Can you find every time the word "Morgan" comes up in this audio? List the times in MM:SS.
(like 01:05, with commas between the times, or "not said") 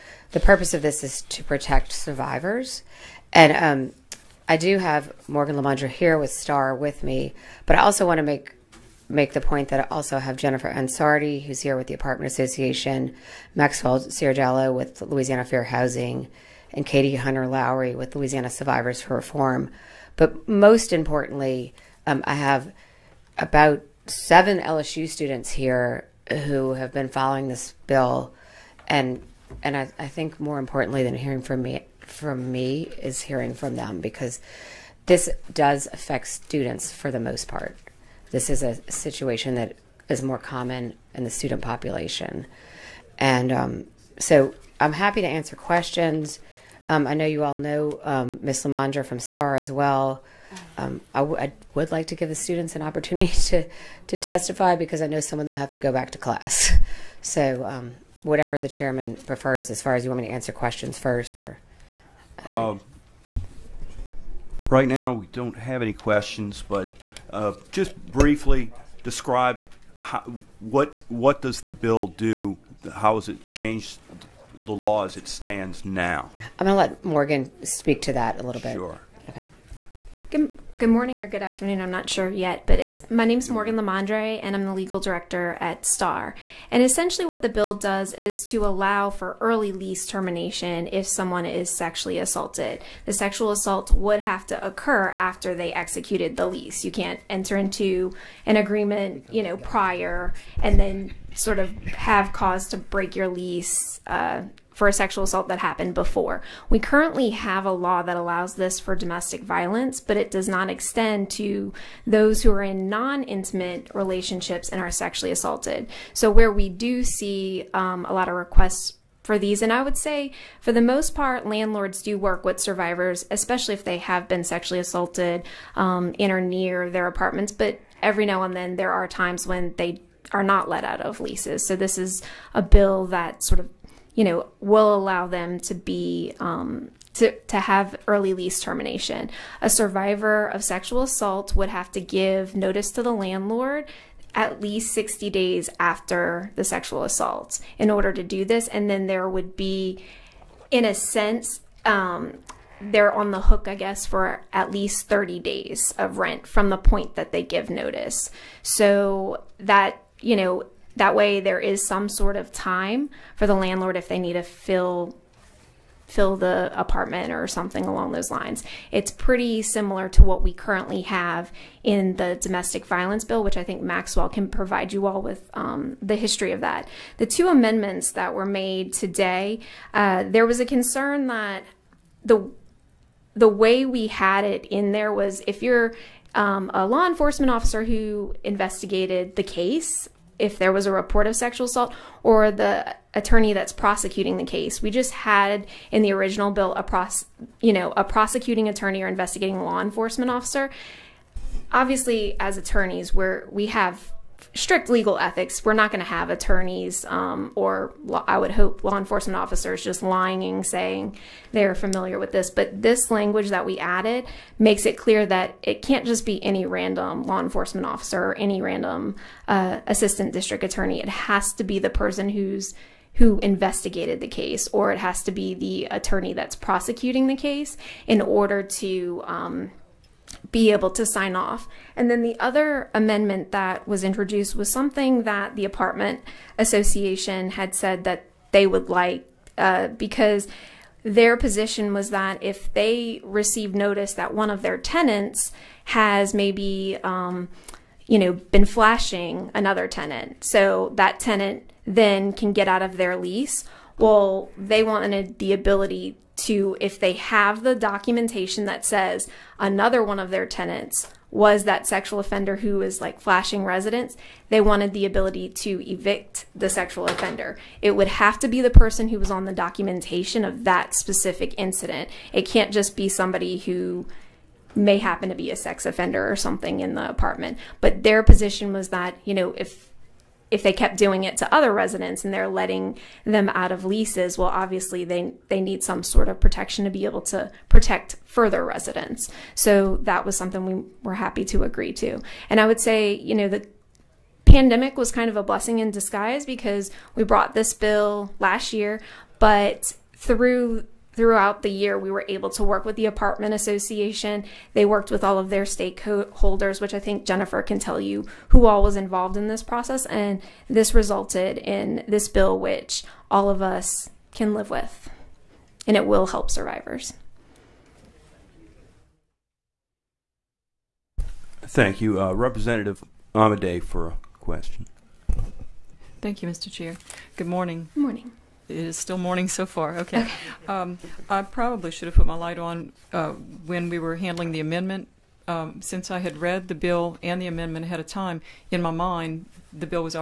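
00:05, 01:17, 01:23.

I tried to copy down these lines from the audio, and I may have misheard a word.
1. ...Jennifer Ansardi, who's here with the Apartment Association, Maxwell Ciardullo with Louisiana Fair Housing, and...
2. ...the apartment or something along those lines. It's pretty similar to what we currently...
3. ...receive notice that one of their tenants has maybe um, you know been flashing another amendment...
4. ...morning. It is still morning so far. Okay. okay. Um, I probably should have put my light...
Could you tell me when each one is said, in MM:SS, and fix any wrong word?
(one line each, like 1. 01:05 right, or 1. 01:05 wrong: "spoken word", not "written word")
1. 00:10 right
2. 02:46 right
3. 04:03 wrong: "tenant", not "amendment"
4. 05:28 right.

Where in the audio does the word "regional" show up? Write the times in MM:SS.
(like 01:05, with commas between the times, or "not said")
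not said.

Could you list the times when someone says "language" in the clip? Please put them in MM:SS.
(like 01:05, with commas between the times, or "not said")
03:33.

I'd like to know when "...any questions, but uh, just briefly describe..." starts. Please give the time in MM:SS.
01:05.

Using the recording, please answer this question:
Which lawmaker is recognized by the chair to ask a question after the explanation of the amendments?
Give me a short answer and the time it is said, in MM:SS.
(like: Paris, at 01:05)
Representative Amedee, at 05:22.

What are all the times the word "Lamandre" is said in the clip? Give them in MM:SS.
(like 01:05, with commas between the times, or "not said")
00:05, 00:48, 01:23.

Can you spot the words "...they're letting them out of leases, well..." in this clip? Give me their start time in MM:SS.
04:42.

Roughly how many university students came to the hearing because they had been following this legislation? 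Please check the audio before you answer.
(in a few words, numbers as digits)
7.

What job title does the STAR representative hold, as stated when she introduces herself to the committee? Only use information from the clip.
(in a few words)
legal director.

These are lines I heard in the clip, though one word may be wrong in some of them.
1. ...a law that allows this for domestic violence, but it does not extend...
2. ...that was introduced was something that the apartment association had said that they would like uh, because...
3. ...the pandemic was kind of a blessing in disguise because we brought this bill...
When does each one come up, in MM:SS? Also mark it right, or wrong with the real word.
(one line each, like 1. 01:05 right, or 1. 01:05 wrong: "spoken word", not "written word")
1. 01:47 right
2. 03:53 right
3. 04:53 right.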